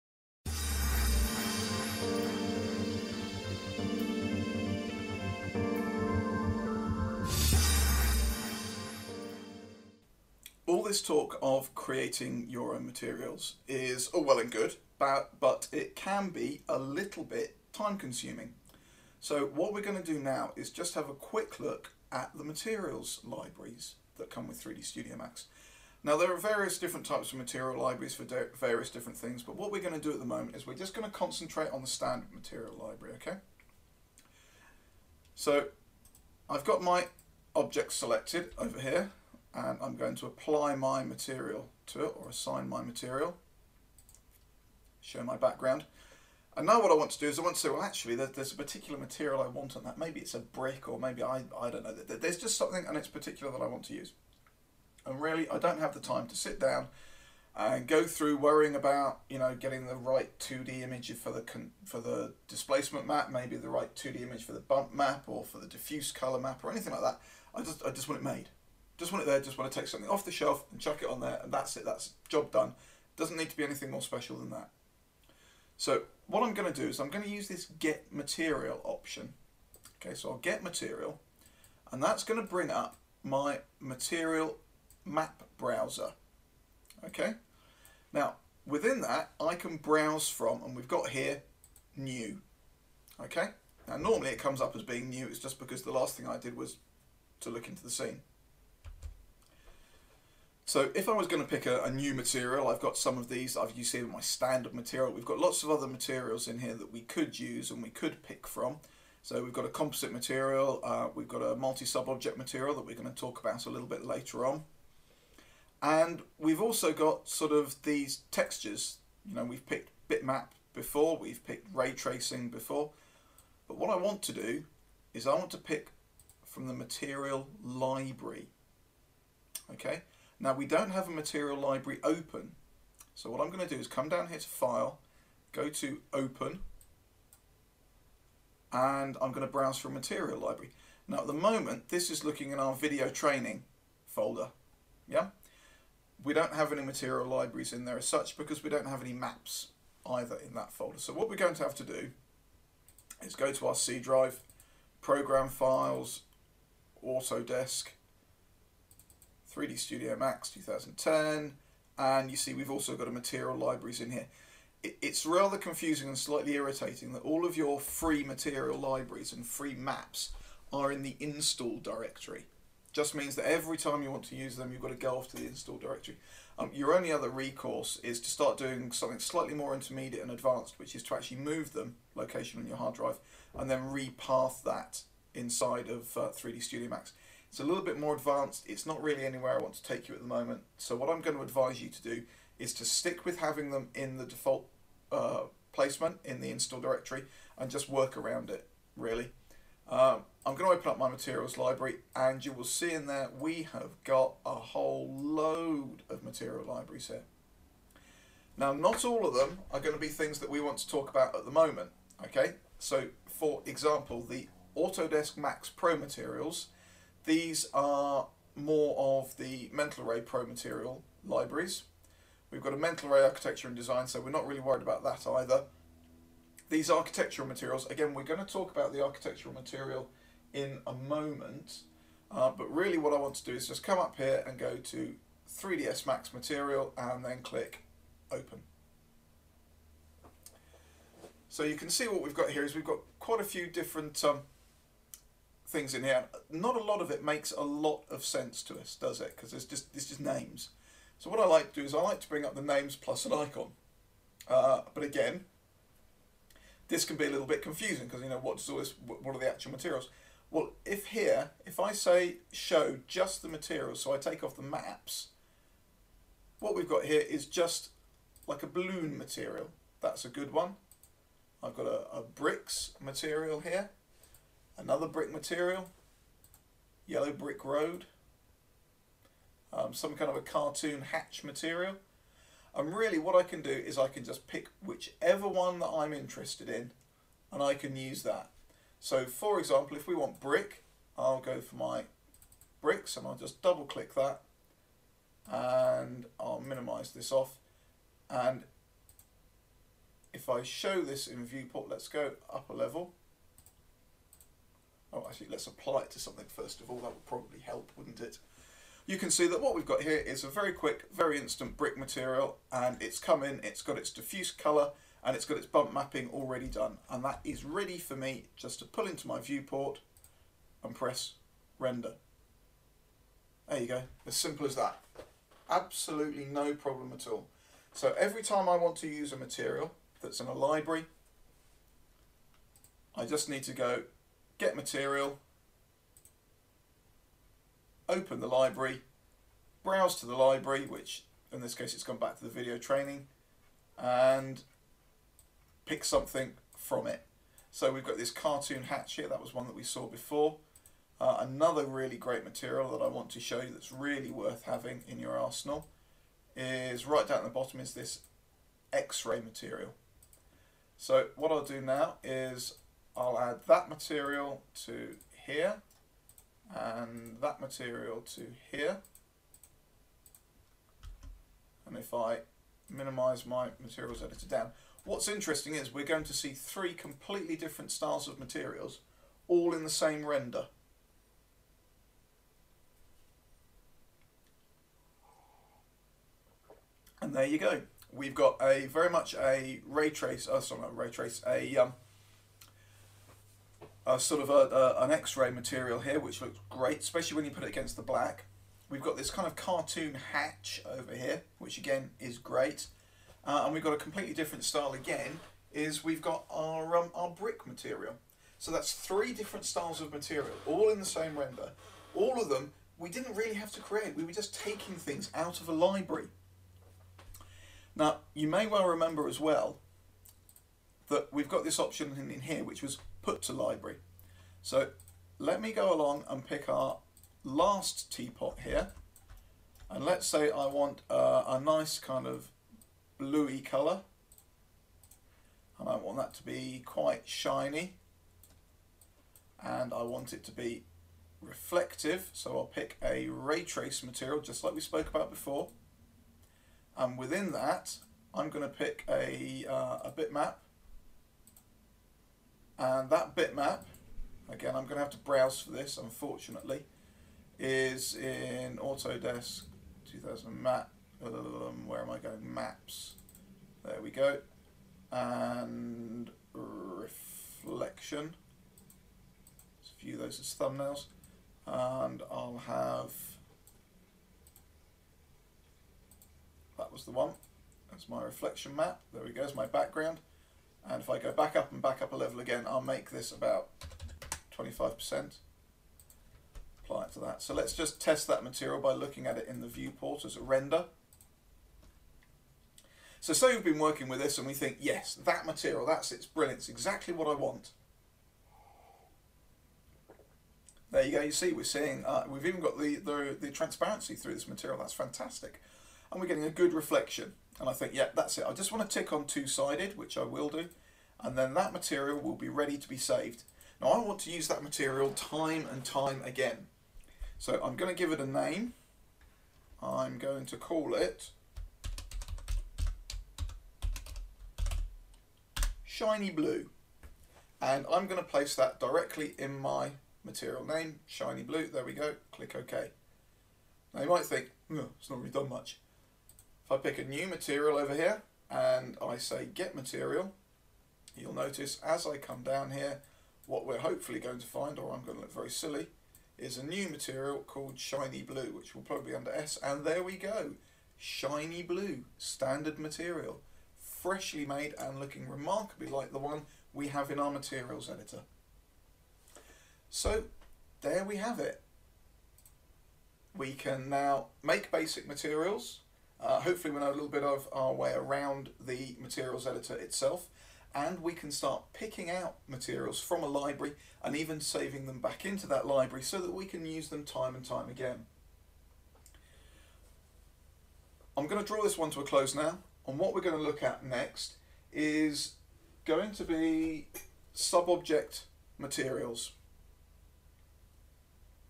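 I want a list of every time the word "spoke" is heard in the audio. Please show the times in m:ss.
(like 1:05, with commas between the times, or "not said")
7:24.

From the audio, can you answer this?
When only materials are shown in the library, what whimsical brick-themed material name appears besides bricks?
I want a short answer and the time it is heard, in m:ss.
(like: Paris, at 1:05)
yellow brick road, at 4:37.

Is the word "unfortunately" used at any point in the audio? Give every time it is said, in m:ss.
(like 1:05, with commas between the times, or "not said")
7:35.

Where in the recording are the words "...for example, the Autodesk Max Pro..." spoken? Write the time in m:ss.
3:33.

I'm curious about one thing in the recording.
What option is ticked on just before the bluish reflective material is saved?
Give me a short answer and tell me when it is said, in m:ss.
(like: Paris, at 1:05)
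two-sided, at 8:29.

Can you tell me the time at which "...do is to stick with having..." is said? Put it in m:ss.
3:12.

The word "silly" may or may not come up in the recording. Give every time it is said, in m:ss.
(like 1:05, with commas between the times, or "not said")
9:05.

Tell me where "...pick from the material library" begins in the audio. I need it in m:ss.
2:05.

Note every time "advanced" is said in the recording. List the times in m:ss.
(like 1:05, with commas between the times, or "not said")
3:00, 3:08.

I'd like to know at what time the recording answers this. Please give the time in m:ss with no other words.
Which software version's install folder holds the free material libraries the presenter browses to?
2:39.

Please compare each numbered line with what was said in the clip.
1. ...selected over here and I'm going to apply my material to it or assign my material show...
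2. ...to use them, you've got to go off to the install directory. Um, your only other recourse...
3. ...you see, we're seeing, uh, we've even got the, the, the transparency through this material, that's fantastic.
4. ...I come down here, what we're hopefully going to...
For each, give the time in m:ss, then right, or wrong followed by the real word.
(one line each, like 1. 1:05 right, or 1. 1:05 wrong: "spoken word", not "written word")
1. 0:37 right
2. 2:54 right
3. 8:21 right
4. 9:02 right.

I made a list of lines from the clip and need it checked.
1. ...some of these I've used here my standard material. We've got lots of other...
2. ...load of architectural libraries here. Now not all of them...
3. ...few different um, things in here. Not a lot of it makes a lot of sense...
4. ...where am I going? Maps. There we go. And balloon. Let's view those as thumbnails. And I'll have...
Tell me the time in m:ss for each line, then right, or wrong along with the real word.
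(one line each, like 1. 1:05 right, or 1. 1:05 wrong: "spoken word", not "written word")
1. 1:42 right
2. 3:25 wrong: "material", not "architectural"
3. 4:03 right
4. 7:41 wrong: "reflection", not "balloon".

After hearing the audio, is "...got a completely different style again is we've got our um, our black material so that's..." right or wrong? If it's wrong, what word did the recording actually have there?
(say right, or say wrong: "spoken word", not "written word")
wrong: "brick", not "black".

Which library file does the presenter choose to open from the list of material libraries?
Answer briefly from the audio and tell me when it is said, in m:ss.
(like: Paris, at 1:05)
3ds Max material, at 3:55.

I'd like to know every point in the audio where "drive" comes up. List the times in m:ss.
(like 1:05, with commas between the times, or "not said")
2:33, 3:02.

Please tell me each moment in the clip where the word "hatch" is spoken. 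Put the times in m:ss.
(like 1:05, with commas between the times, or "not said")
4:41, 5:48, 6:40.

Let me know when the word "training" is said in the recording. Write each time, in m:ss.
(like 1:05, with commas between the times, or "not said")
2:23, 5:42.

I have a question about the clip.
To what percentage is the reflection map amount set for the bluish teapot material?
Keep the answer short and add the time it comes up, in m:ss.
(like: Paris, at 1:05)
25%, at 8:04.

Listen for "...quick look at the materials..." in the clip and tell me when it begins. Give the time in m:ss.
0:21.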